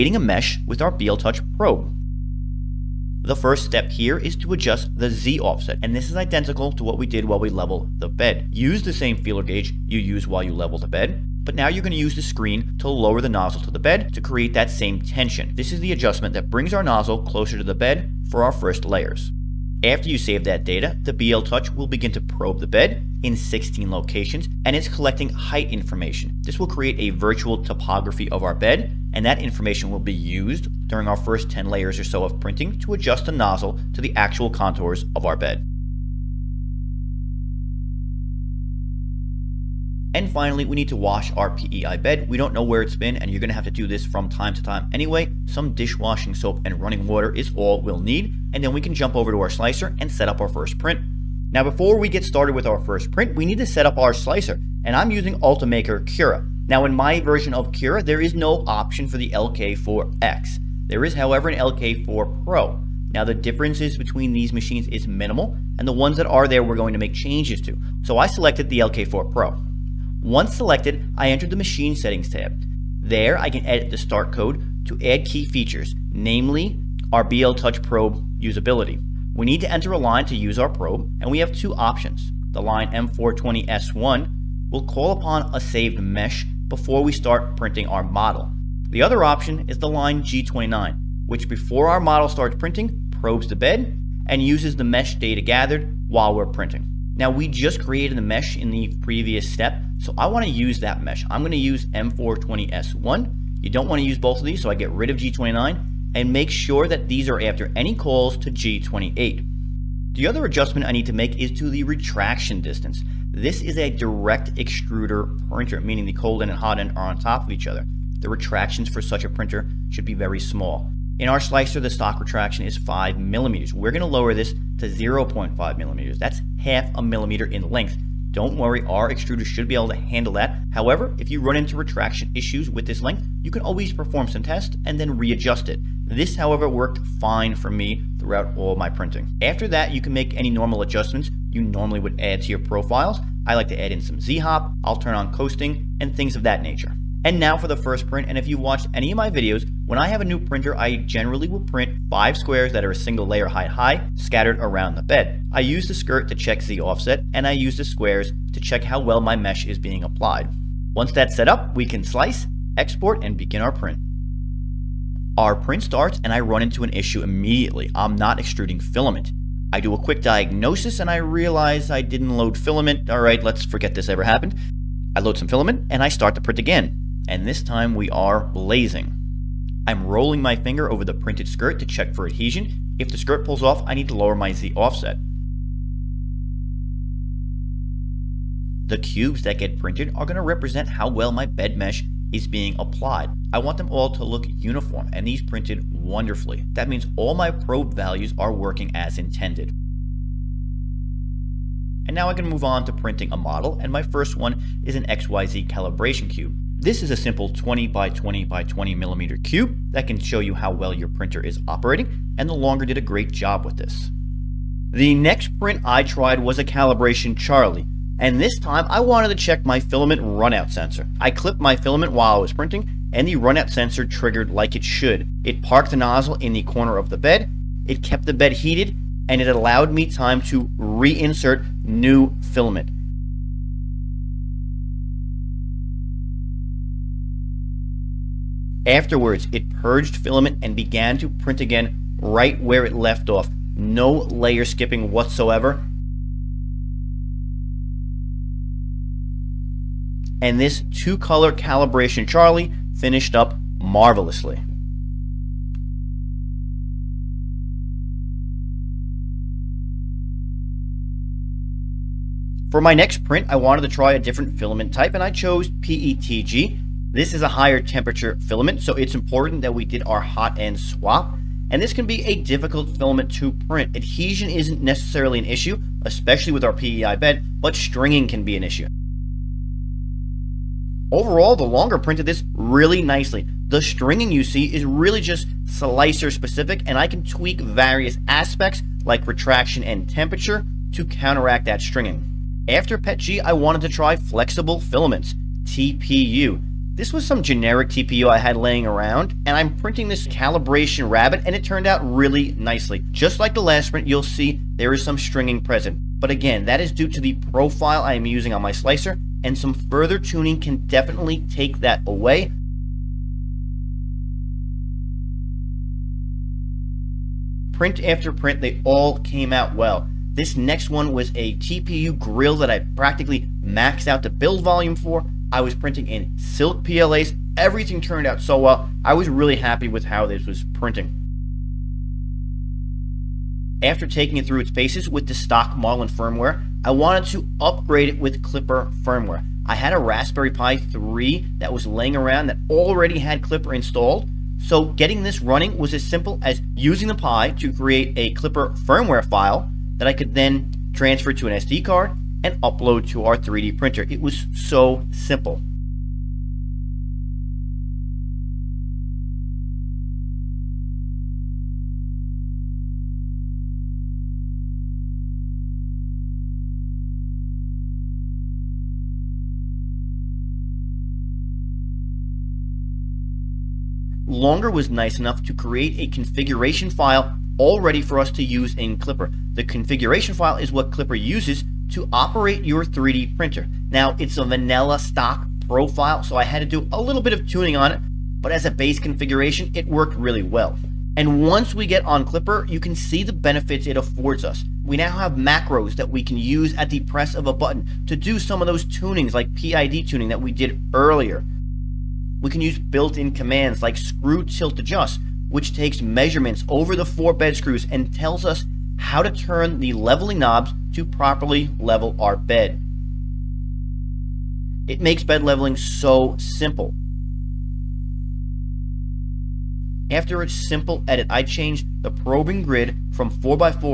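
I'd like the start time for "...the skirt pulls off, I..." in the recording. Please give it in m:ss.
3:03.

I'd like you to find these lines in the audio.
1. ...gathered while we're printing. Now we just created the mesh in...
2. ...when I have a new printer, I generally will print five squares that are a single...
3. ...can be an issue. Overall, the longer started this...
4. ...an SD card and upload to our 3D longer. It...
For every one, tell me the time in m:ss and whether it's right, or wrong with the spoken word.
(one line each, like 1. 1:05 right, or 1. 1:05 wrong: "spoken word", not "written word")
1. 1:35 right
2. 2:29 right
3. 4:38 wrong: "printed", not "started"
4. 5:51 wrong: "printer", not "longer".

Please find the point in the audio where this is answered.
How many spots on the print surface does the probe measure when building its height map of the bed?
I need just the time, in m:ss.
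0:23.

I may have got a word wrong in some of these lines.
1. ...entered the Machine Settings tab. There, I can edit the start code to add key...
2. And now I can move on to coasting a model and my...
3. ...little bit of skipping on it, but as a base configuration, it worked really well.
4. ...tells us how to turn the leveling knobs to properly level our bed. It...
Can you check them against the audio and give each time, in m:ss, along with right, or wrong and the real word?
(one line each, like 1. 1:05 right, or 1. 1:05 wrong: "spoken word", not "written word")
1. 1:11 right
2. 3:22 wrong: "printing", not "coasting"
3. 6:26 wrong: "tuning", not "skipping"
4. 6:48 right.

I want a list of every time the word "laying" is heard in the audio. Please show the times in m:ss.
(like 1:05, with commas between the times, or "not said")
4:58, 5:41.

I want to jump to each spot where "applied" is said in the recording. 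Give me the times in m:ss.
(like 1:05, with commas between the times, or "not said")
2:40, 3:12.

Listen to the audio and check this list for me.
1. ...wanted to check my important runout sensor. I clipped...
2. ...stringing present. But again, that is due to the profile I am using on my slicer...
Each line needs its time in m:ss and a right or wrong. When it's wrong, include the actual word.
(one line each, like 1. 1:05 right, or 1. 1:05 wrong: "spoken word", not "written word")
1. 3:39 wrong: "filament", not "important"
2. 5:05 right.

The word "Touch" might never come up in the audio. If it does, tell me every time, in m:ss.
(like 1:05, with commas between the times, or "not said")
0:01, 0:21, 1:17.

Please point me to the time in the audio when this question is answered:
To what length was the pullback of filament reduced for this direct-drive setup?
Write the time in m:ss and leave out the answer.
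2:04.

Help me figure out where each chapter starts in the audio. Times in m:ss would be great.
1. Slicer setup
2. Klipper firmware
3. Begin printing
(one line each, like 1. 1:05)
1. 0:50
2. 5:34
3. 2:45.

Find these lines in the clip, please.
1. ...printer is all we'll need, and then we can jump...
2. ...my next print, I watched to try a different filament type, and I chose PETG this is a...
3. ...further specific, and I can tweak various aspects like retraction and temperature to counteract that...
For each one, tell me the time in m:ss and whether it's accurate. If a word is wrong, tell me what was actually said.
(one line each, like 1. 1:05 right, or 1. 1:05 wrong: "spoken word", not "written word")
1. 0:47 wrong: "water", not "printer"
2. 4:22 wrong: "wanted", not "watched"
3. 4:45 wrong: "slicer", not "further".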